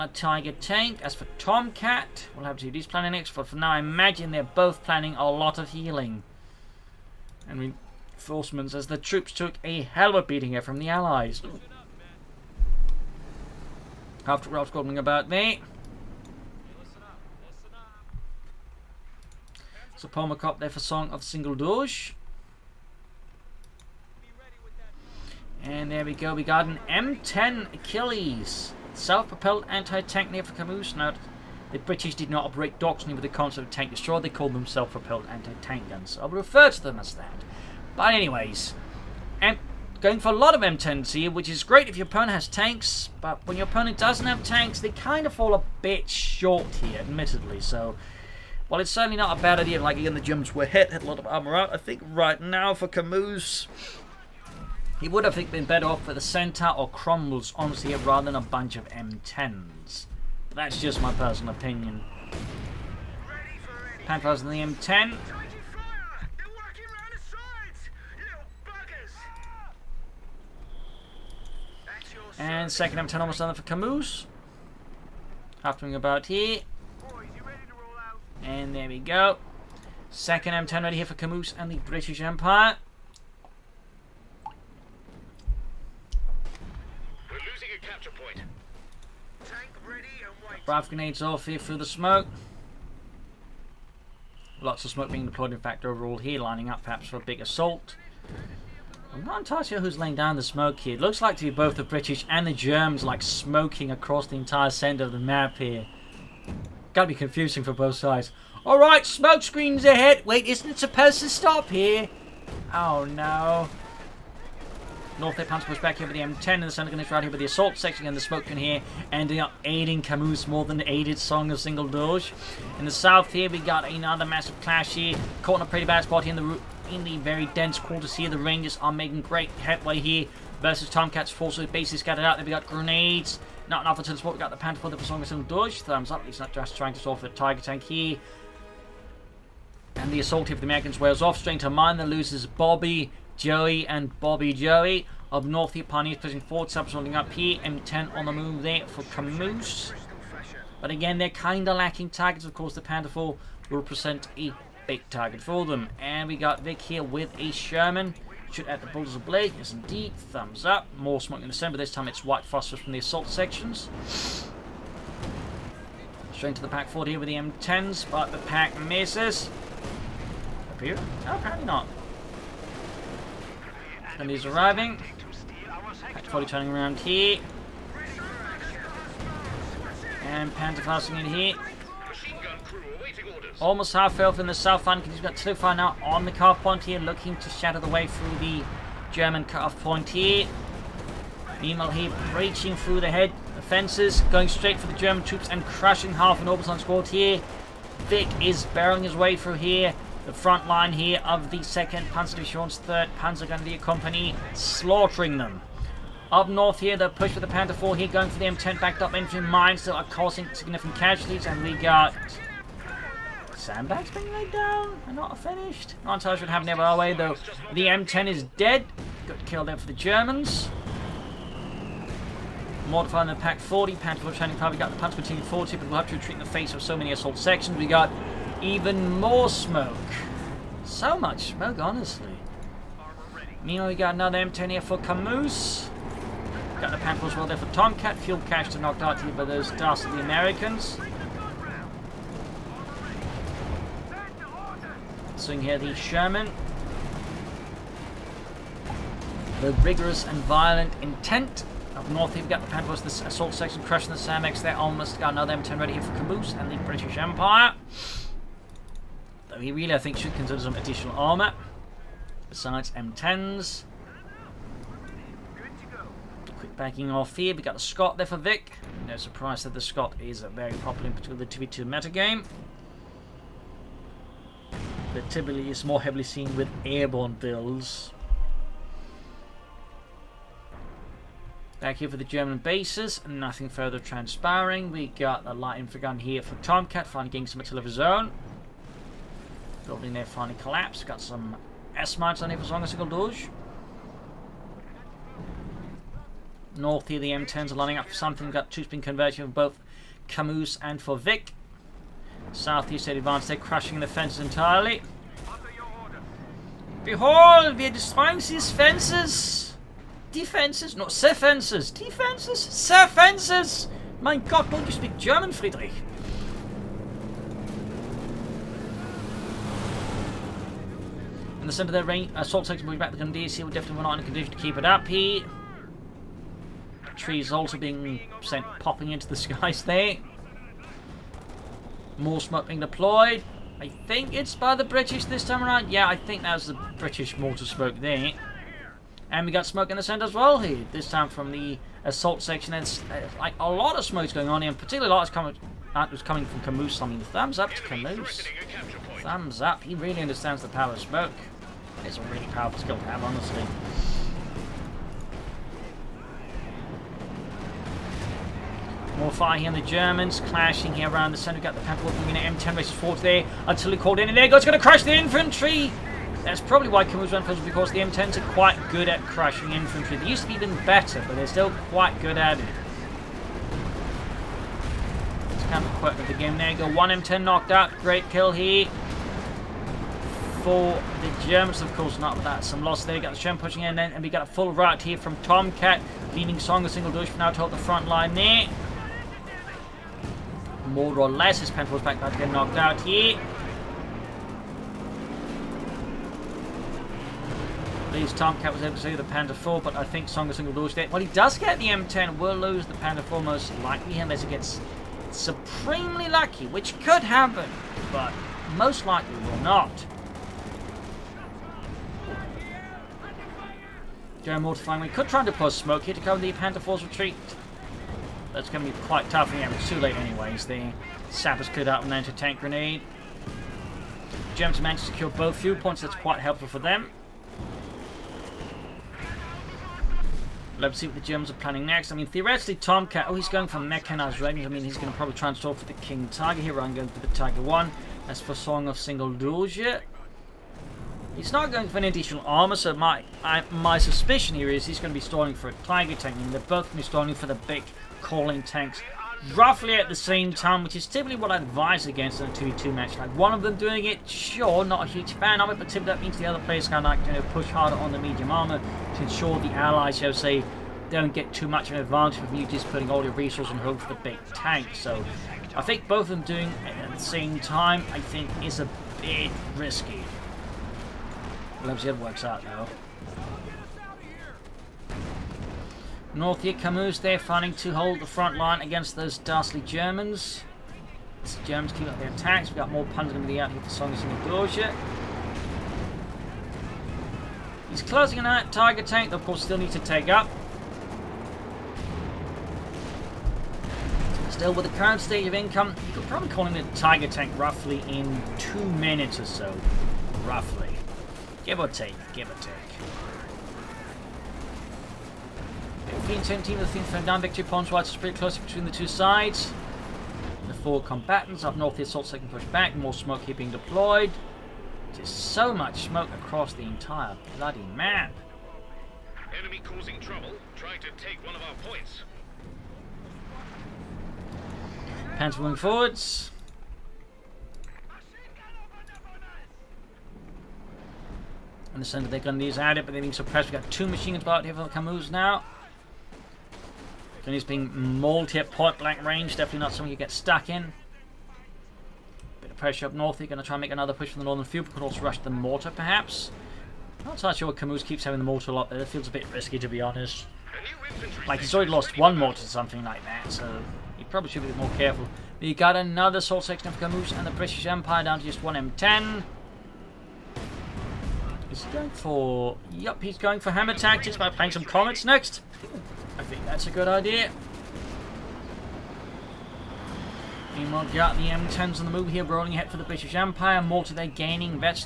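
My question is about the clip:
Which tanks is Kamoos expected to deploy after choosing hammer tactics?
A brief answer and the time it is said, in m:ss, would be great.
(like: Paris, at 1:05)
Comets, at 9:24.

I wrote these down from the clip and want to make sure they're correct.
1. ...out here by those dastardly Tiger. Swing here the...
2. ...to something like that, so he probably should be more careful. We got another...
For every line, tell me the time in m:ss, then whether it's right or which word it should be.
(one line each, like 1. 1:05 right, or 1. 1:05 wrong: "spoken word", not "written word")
1. 3:59 wrong: "Americans", not "Tiger"
2. 9:12 right.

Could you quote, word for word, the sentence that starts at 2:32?
Of course, the Pantherful will present a big target for them.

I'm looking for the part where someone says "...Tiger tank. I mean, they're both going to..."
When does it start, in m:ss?
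7:25.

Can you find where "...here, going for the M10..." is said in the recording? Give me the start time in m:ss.
3:27.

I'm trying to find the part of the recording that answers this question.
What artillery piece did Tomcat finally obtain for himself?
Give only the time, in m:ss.
4:45.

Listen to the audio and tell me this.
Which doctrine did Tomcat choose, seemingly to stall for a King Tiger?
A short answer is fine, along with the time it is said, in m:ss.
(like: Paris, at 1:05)
Mechanized, at 7:13.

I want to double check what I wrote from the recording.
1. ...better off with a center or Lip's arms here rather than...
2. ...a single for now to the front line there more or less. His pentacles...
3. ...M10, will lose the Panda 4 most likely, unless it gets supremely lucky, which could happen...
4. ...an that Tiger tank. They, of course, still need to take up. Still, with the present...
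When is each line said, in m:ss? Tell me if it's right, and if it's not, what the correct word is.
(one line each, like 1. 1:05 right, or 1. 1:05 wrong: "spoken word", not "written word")
1. 0:55 wrong: "Cromwell", not "Lip"
2. 6:26 right
3. 6:41 right
4. 8:08 wrong: "current", not "present".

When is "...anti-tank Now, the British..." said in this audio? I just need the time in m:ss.
0:29.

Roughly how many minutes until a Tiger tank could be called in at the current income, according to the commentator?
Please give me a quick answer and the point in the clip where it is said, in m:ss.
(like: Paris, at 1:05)
2, at 8:18.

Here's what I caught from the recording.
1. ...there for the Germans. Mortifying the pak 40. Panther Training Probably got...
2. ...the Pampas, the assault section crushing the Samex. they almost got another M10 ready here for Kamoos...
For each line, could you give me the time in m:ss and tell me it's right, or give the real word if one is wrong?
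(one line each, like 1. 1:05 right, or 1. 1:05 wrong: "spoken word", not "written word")
1. 3:39 right
2. 4:12 right.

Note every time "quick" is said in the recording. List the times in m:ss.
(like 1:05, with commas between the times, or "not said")
4:26, 6:15.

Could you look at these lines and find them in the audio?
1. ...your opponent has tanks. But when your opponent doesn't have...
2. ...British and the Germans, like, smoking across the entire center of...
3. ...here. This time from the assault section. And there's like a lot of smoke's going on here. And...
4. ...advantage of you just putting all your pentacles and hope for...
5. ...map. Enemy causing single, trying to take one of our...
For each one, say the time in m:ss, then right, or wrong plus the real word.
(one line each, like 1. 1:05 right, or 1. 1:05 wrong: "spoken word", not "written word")
1. 0:41 right
2. 1:41 right
3. 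5:40 right
4. 7:42 wrong: "resources", not "pentacles"
5. 8:37 wrong: "trouble", not "single".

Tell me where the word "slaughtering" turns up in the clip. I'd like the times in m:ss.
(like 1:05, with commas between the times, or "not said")
3:24.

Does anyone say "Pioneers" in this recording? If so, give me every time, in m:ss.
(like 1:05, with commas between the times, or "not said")
2:25.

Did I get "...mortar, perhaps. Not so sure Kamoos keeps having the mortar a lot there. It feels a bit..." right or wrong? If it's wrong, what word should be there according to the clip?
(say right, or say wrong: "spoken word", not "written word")
right.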